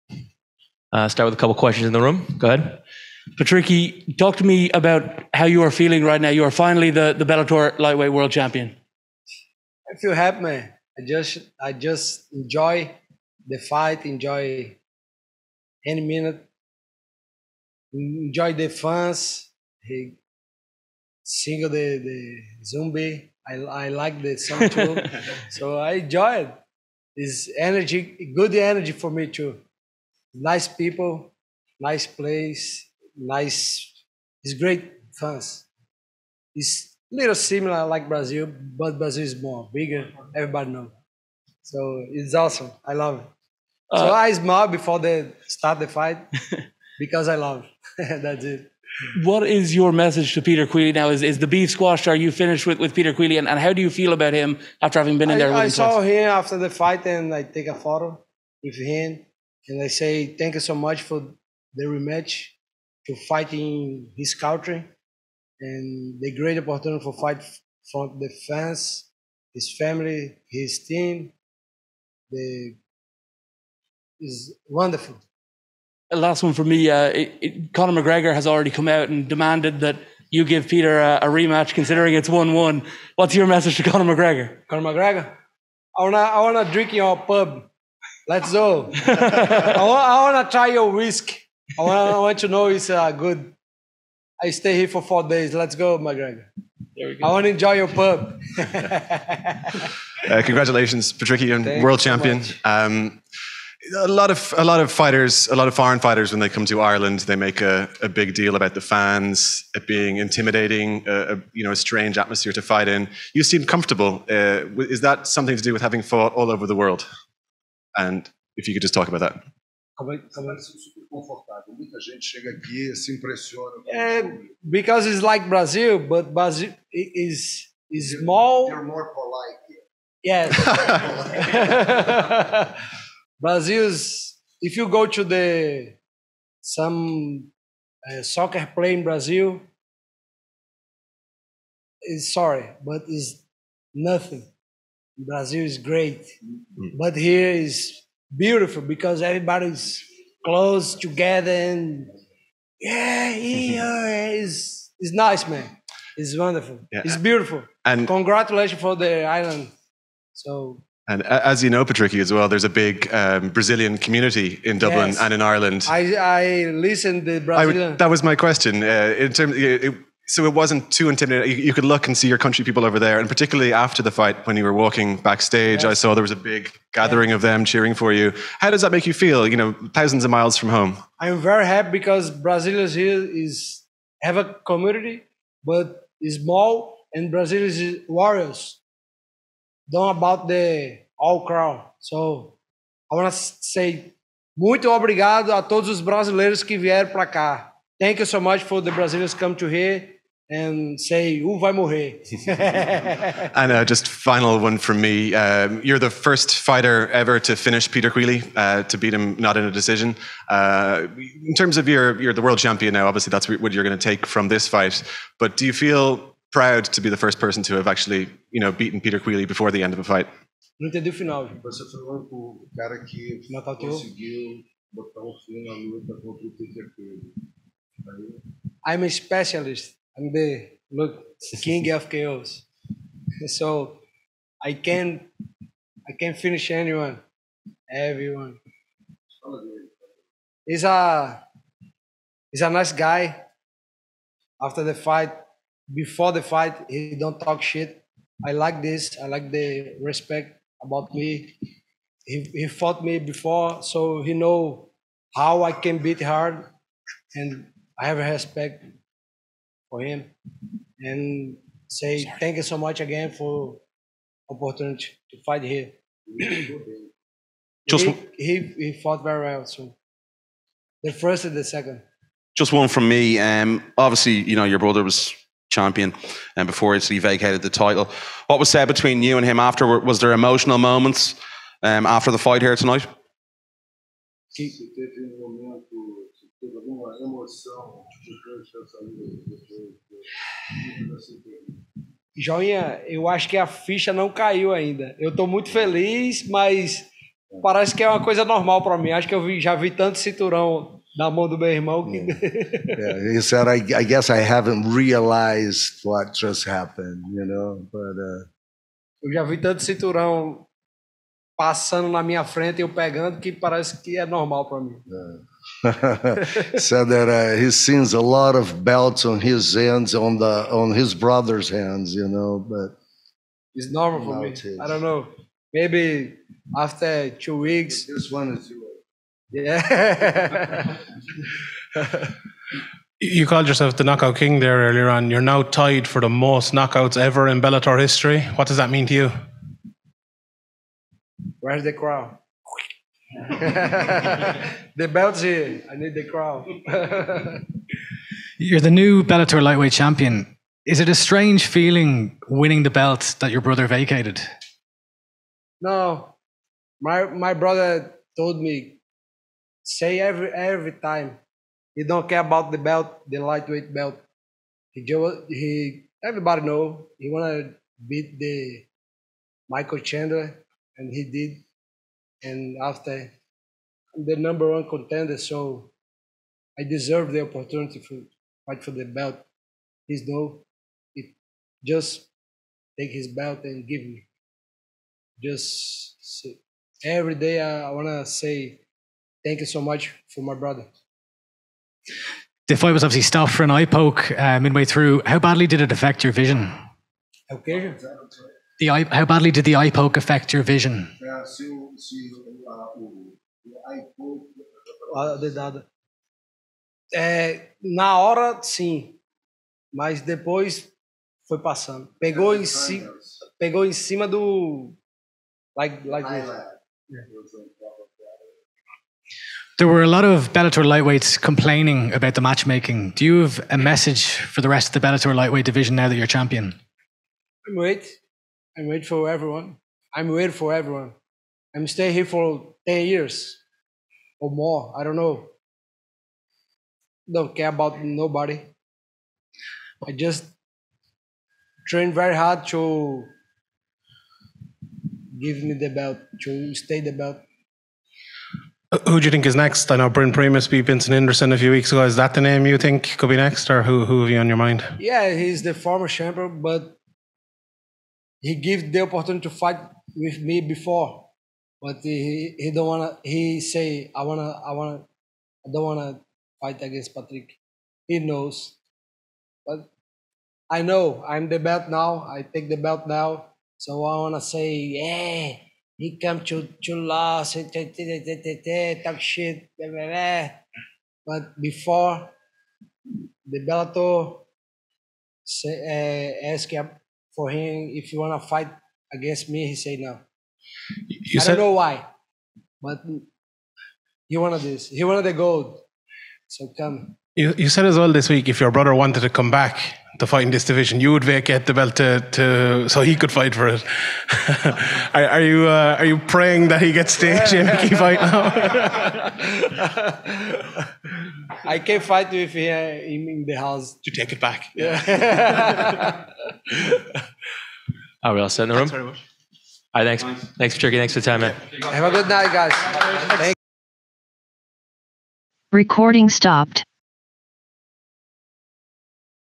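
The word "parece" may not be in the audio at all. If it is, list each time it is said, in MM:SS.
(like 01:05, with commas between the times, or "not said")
04:57, 05:13.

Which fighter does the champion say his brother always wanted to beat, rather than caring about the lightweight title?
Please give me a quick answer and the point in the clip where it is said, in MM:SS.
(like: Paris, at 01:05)
Michael Chandler, at 06:09.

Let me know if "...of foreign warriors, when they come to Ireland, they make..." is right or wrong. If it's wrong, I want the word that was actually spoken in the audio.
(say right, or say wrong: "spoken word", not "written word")
wrong: "fighters", not "warriors".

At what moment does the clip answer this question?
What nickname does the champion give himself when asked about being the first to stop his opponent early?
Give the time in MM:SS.
03:51.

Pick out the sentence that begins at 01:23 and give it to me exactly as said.
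What's your message to Conor McGregor?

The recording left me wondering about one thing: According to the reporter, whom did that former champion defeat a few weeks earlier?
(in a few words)
Vincent Anderson.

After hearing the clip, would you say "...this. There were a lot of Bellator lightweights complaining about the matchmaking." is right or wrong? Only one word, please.
right.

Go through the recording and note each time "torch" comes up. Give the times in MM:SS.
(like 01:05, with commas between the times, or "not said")
not said.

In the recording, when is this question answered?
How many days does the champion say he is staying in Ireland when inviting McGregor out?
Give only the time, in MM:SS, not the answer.
01:35.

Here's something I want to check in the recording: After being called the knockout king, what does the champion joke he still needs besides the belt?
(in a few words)
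the crown.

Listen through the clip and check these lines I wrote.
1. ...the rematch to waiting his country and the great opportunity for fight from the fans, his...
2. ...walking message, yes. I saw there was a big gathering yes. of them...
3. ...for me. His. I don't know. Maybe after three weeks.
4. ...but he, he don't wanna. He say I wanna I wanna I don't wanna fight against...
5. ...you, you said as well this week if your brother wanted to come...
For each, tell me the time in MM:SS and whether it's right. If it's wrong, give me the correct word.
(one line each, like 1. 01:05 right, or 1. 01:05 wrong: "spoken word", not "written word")
1. 01:01 wrong: "fighting", not "waiting"
2. 02:54 wrong: "backstage", not "message"
3. 05:24 wrong: "two", not "three"
4. 07:41 right
5. 08:17 right.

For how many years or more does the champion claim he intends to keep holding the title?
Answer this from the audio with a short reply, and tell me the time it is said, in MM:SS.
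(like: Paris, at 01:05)
10, at 07:12.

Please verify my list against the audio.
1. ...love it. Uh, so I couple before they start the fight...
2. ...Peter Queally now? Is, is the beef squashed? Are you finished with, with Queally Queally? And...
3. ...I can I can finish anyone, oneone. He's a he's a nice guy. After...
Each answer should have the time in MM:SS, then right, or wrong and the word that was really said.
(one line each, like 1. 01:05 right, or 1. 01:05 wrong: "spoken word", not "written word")
1. 00:42 wrong: "smile", not "couple"
2. 00:50 wrong: "Peter", not "Queally"
3. 03:54 wrong: "everyone", not "oneone".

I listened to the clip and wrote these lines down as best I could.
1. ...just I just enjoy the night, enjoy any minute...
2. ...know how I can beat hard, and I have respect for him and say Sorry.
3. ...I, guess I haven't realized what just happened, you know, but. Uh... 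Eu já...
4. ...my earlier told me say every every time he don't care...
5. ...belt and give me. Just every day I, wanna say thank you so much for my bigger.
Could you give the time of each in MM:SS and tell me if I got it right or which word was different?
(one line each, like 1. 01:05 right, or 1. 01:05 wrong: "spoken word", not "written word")
1. 00:11 wrong: "fight", not "night"
2. 04:14 right
3. 05:03 right
4. 05:57 wrong: "brother", not "earlier"
5. 06:23 wrong: "brother", not "bigger".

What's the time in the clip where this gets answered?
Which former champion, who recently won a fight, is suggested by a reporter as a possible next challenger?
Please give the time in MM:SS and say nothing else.
07:30.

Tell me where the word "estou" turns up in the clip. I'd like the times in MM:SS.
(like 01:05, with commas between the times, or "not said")
04:55.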